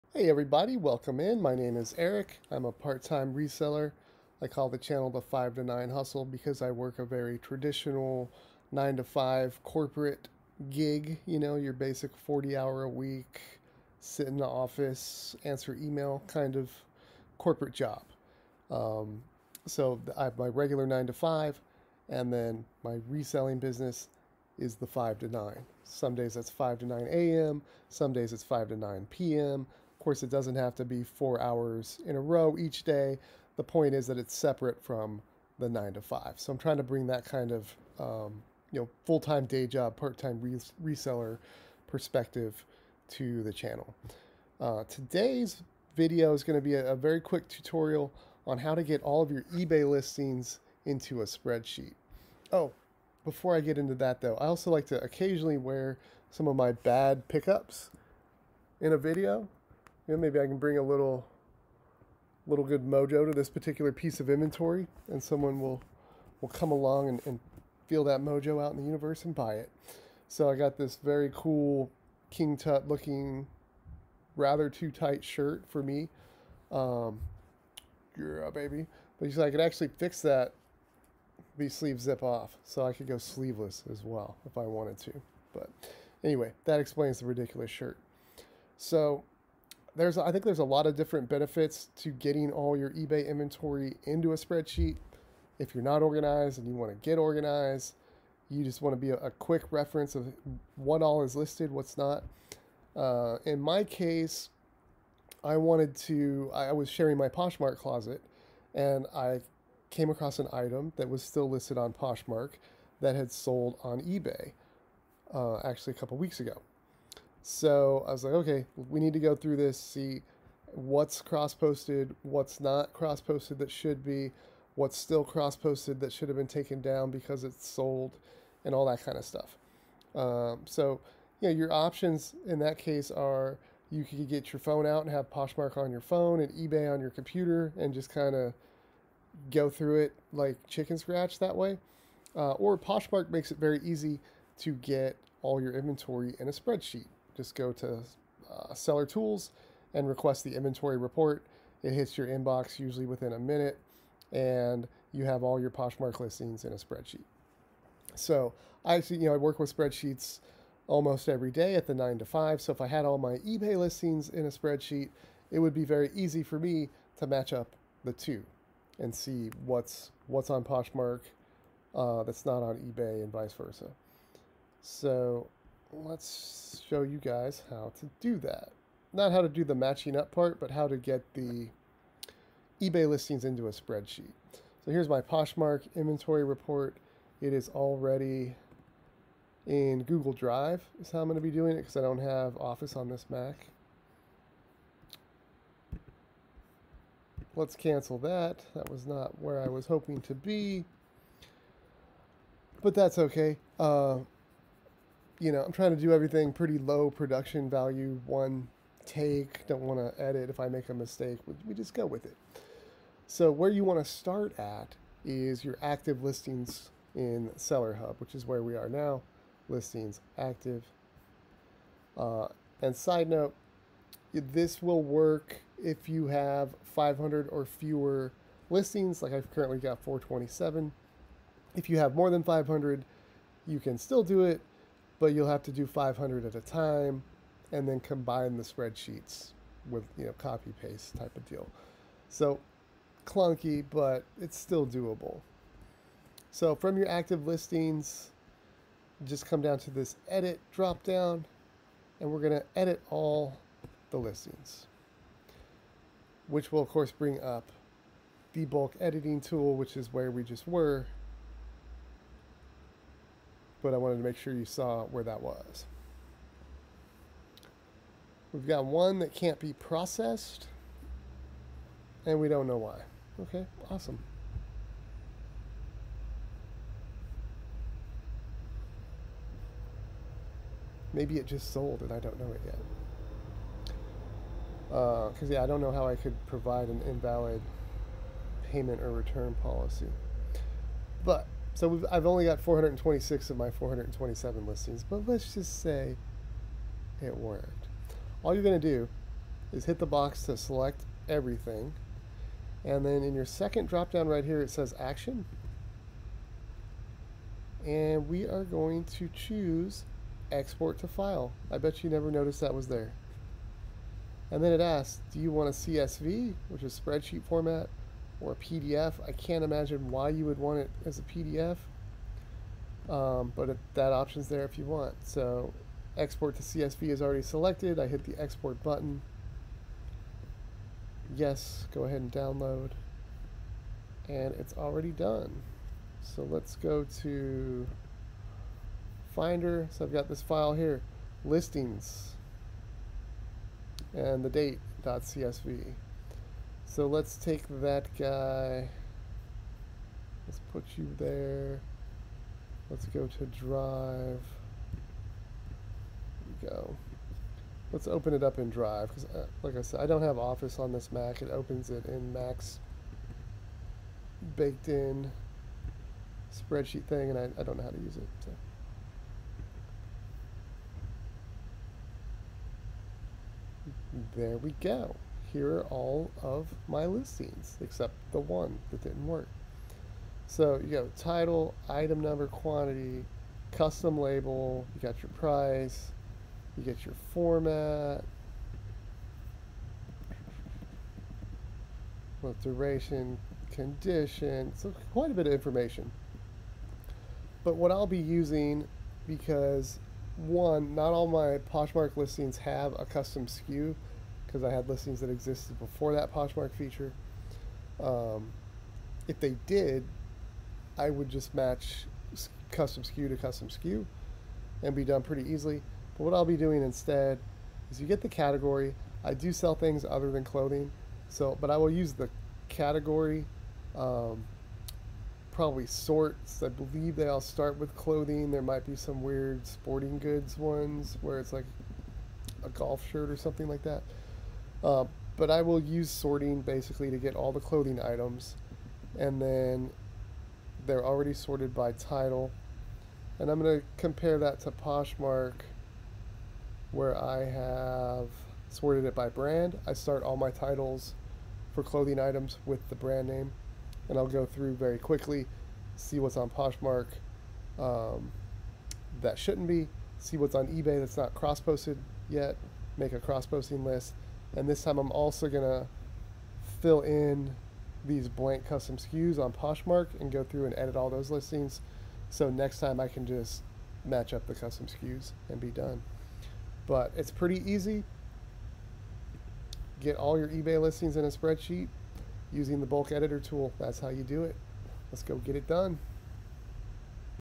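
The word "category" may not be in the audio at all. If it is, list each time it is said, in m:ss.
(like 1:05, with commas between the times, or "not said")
6:58, 7:02.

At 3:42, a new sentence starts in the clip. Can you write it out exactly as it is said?
Uh, and side note, this will work if you have 500 or fewer listings, like I've currently got 427.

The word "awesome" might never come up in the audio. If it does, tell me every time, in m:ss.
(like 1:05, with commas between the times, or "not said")
4:33.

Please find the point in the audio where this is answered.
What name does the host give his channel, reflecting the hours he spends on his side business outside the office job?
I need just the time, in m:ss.
0:05.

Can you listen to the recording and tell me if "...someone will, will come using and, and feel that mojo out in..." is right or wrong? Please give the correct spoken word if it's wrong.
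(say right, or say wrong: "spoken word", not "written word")
wrong: "along", not "using".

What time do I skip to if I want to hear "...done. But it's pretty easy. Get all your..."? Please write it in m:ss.
7:55.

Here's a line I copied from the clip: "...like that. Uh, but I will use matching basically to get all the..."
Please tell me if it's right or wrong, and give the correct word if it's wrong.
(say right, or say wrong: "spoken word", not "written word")
wrong: "sorting", not "matching".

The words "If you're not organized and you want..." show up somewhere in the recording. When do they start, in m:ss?
1:35.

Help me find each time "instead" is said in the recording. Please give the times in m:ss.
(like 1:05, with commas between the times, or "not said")
6:56.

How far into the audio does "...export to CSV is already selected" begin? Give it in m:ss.
5:26.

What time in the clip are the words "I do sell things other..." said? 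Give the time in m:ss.
6:59.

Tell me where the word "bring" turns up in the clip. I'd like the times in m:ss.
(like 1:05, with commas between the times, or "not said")
0:36, 1:00, 4:17.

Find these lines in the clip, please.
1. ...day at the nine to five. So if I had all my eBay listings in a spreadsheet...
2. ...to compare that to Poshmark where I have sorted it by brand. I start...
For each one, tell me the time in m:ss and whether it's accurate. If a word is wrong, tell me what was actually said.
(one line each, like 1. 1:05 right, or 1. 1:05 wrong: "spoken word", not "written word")
1. 2:41 right
2. 7:23 right.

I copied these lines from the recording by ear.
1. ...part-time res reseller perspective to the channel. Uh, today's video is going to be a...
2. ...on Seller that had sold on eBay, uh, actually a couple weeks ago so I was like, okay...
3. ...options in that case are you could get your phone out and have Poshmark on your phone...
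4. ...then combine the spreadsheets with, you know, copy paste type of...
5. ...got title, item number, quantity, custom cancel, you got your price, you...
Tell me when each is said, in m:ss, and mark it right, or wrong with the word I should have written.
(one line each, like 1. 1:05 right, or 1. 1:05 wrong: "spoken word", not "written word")
1. 0:39 right
2. 1:51 wrong: "Poshmark", not "Seller"
3. 2:11 right
4. 3:57 right
5. 6:20 wrong: "label", not "cancel".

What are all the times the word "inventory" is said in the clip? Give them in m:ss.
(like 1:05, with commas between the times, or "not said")
1:04, 1:33, 2:25, 2:30, 3:05.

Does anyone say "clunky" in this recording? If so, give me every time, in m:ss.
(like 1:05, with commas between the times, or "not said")
4:03.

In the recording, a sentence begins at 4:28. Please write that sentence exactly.
We've got one that can't be processed, and we don't know why.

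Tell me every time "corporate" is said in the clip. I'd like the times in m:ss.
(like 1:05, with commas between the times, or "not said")
0:09, 0:17.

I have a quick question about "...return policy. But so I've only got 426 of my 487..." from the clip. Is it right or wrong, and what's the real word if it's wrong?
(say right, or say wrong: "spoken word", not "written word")
wrong: "427", not "487".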